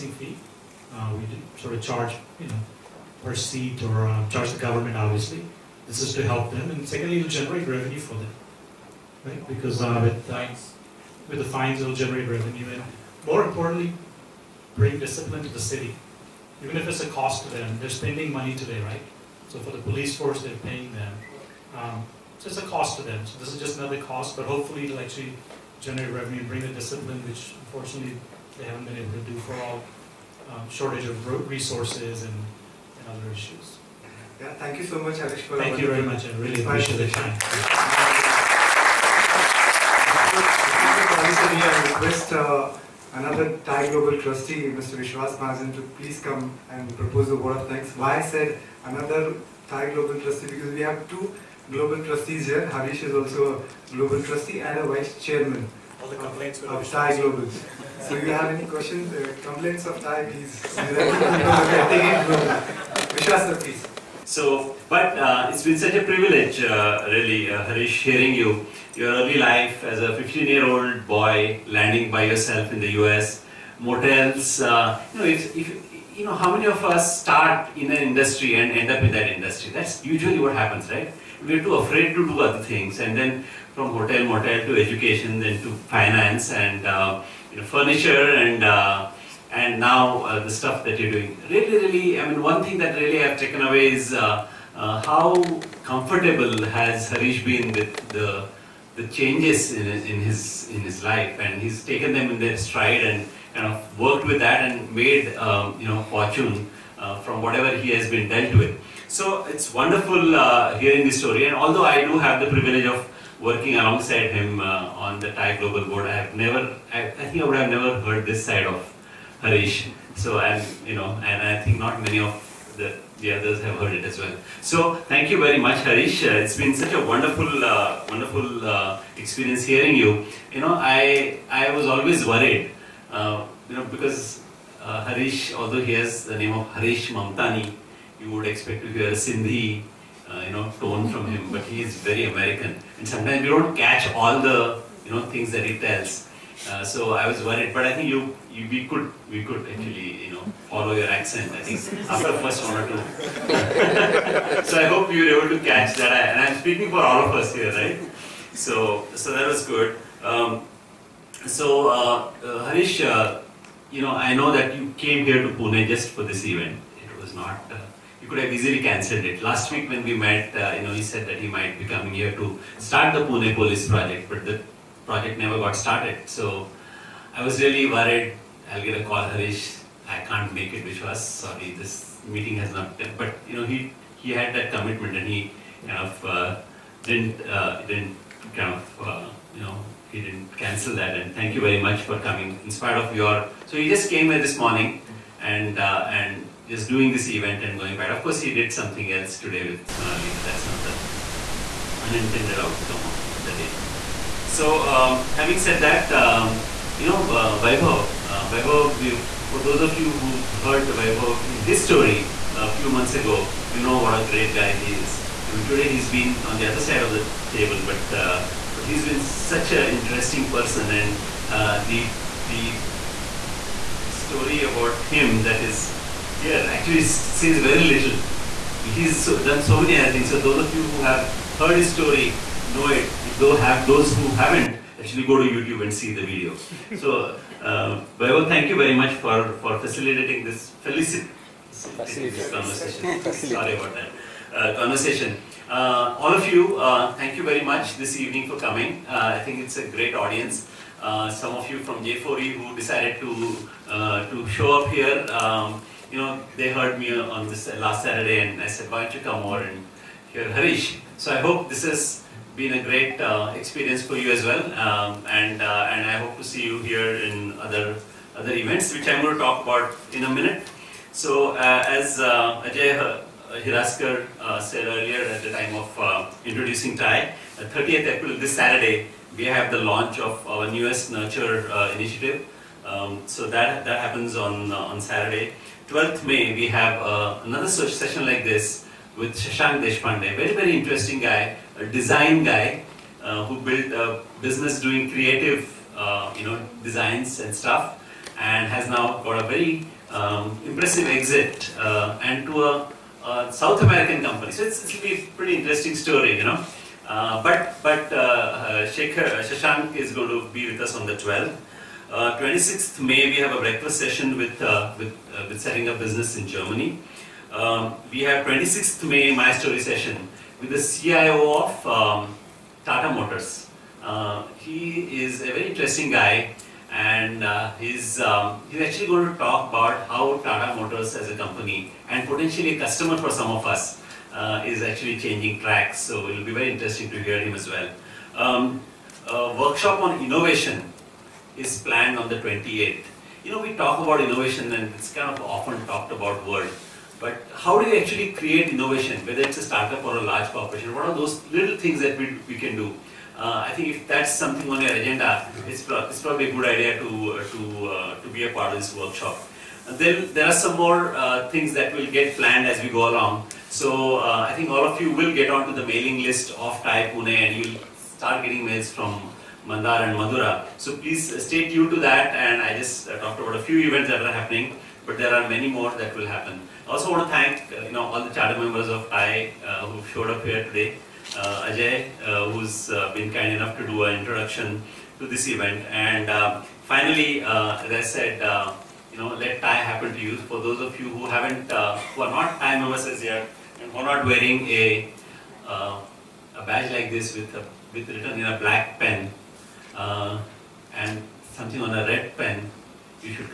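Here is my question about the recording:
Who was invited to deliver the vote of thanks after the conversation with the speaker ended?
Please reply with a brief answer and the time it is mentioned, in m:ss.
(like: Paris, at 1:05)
Vishwas Mahajan, at 0:44.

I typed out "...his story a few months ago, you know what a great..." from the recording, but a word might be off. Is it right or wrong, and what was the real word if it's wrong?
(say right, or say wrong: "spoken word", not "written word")
right.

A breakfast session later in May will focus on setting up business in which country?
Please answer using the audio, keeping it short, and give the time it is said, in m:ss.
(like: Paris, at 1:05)
Germany, at 5:16.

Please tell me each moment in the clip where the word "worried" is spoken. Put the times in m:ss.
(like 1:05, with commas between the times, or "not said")
2:12, 2:27, 2:57.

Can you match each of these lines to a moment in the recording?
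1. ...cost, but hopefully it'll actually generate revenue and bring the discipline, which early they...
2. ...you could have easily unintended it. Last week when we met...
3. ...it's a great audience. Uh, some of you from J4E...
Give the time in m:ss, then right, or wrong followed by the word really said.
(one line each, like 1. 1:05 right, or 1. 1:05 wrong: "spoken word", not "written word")
1. 0:24 wrong: "unfortunately", not "early"
2. 2:48 wrong: "cancelled", not "unintended"
3. 4:09 right.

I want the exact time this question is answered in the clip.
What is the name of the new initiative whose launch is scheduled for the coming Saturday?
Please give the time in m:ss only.
4:41.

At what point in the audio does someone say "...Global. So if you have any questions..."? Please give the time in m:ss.
0:57.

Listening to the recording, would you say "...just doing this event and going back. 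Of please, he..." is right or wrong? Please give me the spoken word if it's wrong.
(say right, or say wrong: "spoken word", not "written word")
wrong: "course", not "please".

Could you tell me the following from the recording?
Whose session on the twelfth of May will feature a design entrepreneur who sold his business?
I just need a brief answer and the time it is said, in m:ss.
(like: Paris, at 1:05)
Shashank Deshpande, at 4:49.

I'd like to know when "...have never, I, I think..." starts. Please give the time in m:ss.
1:56.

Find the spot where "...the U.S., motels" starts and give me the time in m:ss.
1:12.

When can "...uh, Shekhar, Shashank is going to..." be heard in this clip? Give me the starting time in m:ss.
5:08.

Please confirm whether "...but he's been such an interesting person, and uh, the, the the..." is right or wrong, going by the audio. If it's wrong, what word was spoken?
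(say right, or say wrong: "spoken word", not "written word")
right.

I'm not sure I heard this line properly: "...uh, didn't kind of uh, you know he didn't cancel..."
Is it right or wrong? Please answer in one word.
right.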